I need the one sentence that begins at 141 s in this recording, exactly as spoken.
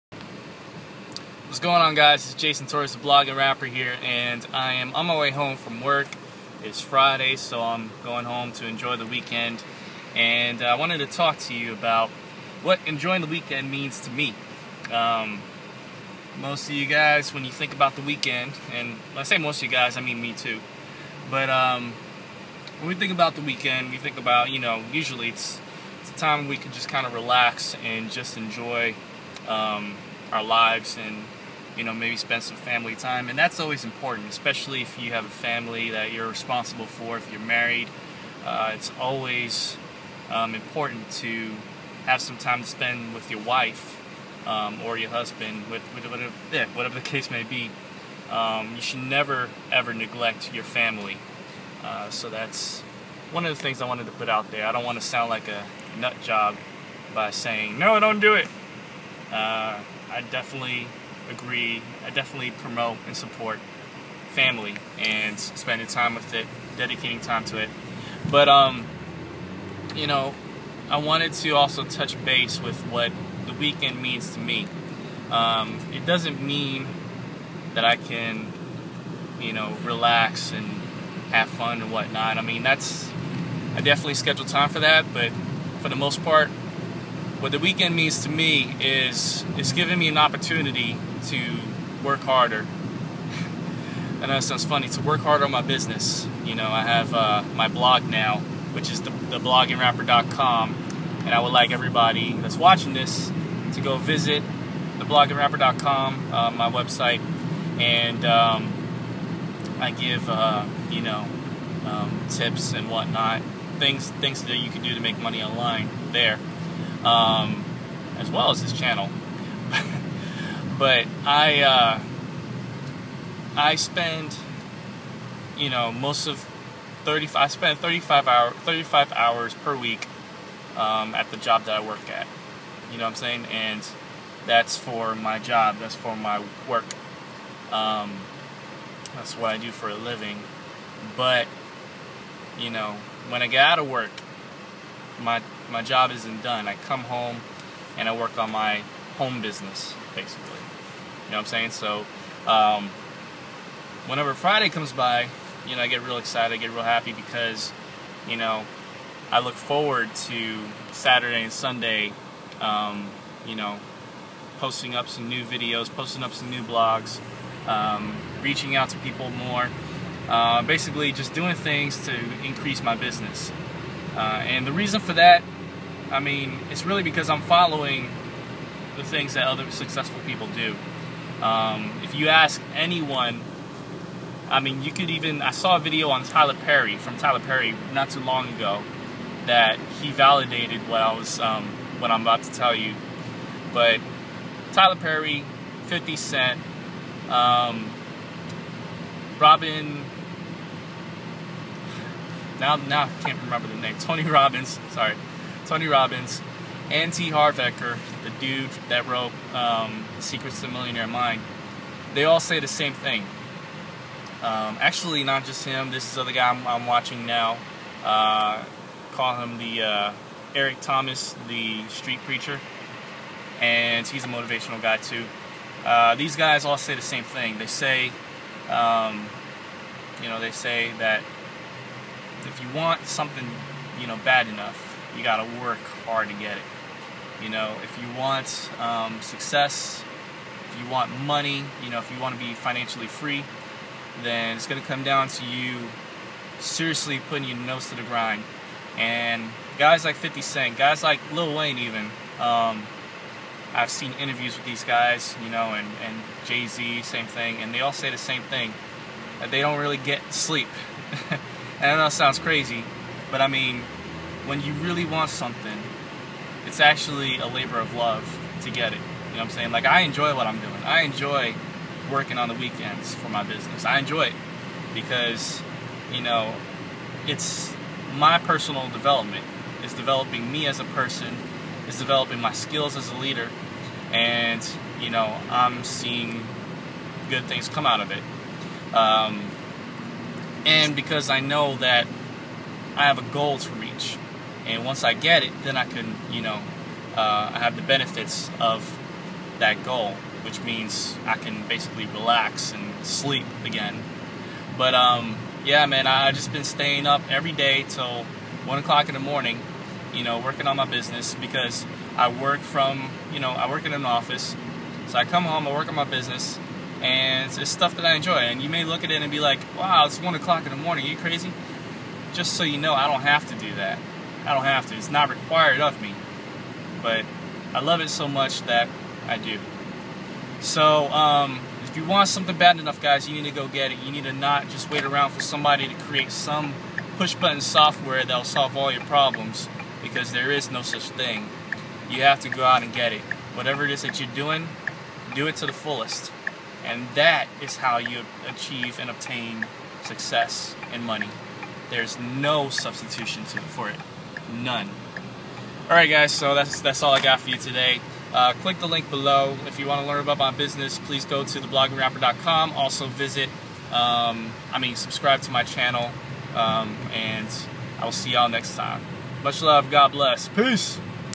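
But you know, when I get out of work, my my job isn't done.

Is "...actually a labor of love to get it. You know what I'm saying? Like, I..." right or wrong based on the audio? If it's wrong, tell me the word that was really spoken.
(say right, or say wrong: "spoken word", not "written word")
right.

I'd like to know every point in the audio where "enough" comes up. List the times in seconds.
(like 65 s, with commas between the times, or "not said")
234 s, 332 s.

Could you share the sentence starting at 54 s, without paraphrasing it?
I don't want to sound like a nut job by saying, no, don't do it.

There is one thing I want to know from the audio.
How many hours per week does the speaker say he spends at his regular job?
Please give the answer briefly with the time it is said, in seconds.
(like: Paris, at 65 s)
35, at 128 s.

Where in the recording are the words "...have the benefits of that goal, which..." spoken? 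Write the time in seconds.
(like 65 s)
297 s.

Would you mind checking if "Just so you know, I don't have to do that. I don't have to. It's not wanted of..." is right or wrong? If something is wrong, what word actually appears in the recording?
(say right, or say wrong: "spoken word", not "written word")
wrong: "required", not "wanted".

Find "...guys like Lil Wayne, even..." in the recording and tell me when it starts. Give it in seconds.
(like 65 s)
250 s.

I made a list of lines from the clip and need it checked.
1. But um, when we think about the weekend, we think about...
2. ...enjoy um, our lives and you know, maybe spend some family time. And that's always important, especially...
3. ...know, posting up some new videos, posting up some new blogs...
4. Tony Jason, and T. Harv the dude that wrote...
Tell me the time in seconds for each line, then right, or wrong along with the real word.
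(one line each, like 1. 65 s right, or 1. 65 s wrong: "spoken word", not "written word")
1. 21 s right
2. 28 s right
3. 163 s right
4. 205 s wrong: "Robbins", not "Jason".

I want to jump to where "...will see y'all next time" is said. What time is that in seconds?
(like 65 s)
368 s.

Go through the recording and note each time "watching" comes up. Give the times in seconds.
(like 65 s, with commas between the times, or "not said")
102 s, 216 s.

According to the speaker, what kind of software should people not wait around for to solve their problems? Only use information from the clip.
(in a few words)
push button software.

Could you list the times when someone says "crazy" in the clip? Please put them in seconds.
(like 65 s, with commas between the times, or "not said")
262 s, 321 s.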